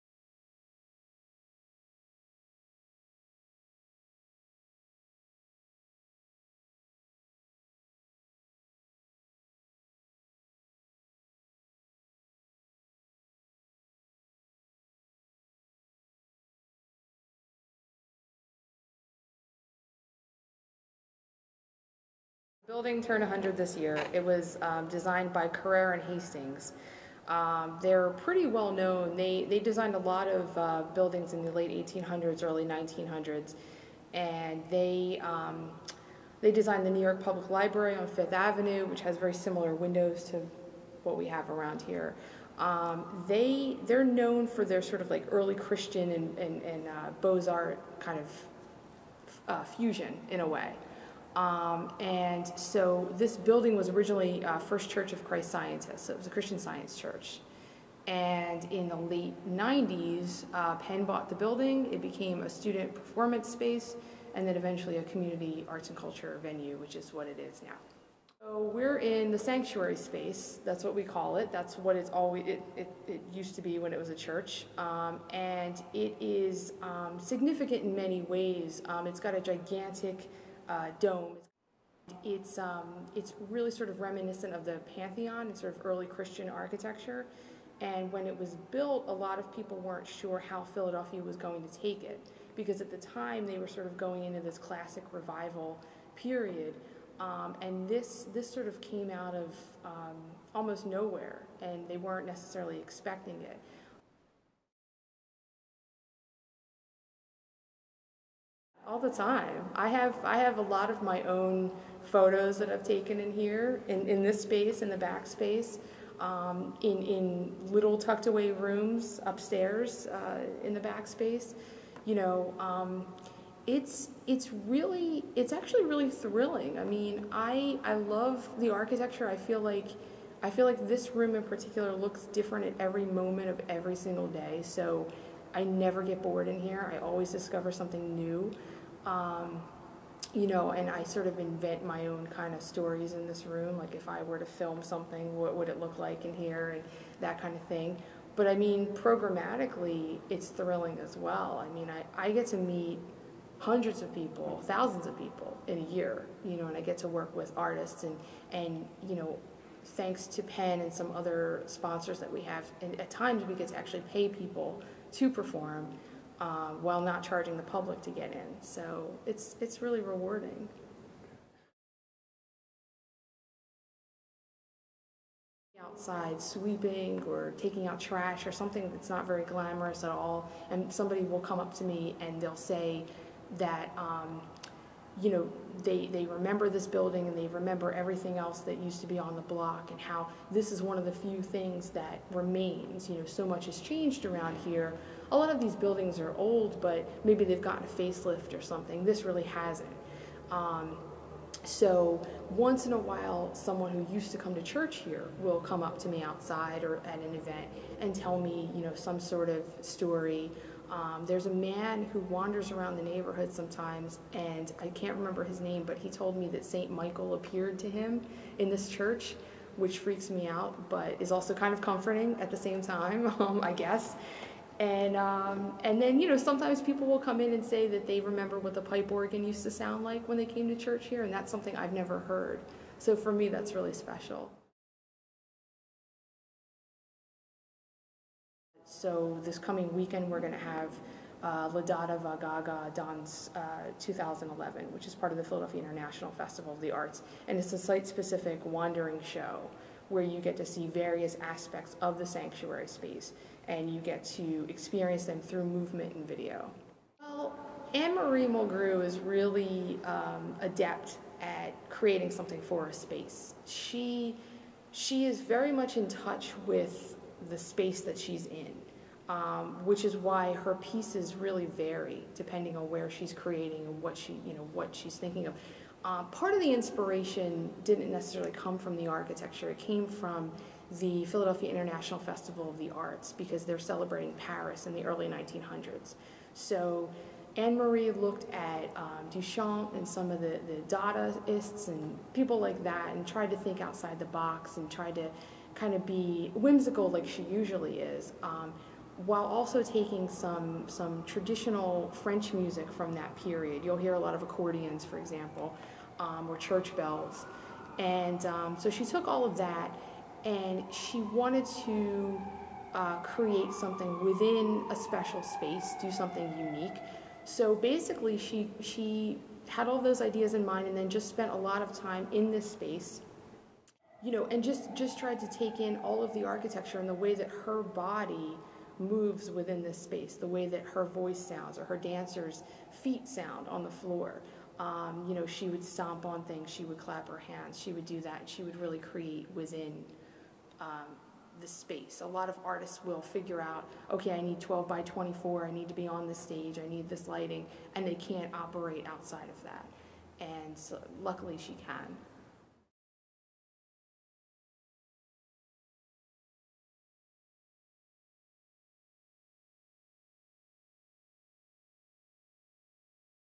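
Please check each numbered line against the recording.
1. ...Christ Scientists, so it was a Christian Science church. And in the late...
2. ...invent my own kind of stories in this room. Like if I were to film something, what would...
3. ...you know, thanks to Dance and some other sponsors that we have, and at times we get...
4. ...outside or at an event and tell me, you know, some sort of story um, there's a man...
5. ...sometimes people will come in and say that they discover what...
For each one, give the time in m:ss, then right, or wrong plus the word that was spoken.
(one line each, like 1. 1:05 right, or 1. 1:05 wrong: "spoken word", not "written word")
1. 0:55 right
2. 2:21 right
3. 2:39 wrong: "Penn", not "Dance"
4. 3:26 right
5. 3:46 wrong: "remember", not "discover".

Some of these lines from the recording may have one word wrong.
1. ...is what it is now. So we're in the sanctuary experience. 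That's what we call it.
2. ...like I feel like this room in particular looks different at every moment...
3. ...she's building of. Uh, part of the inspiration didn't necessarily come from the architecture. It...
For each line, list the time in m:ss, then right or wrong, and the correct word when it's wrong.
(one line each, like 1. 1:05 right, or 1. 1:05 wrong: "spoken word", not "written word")
1. 1:06 wrong: "space", not "experience"
2. 2:09 right
3. 4:34 wrong: "thinking", not "building".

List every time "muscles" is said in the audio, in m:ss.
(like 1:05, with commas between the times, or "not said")
not said.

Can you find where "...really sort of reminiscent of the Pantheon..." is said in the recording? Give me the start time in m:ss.
1:23.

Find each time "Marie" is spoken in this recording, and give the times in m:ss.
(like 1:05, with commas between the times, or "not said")
4:17, 4:47.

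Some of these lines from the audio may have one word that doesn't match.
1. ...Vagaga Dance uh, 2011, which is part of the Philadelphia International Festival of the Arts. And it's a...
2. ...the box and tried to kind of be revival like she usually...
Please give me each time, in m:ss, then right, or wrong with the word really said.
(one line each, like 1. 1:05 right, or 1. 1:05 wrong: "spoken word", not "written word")
1. 4:02 right
2. 4:54 wrong: "whimsical", not "revival".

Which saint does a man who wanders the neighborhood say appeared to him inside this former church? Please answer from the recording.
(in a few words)
St. Michael.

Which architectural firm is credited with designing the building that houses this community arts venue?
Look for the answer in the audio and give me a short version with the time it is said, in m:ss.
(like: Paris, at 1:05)
Carrere and Hastings, at 0:25.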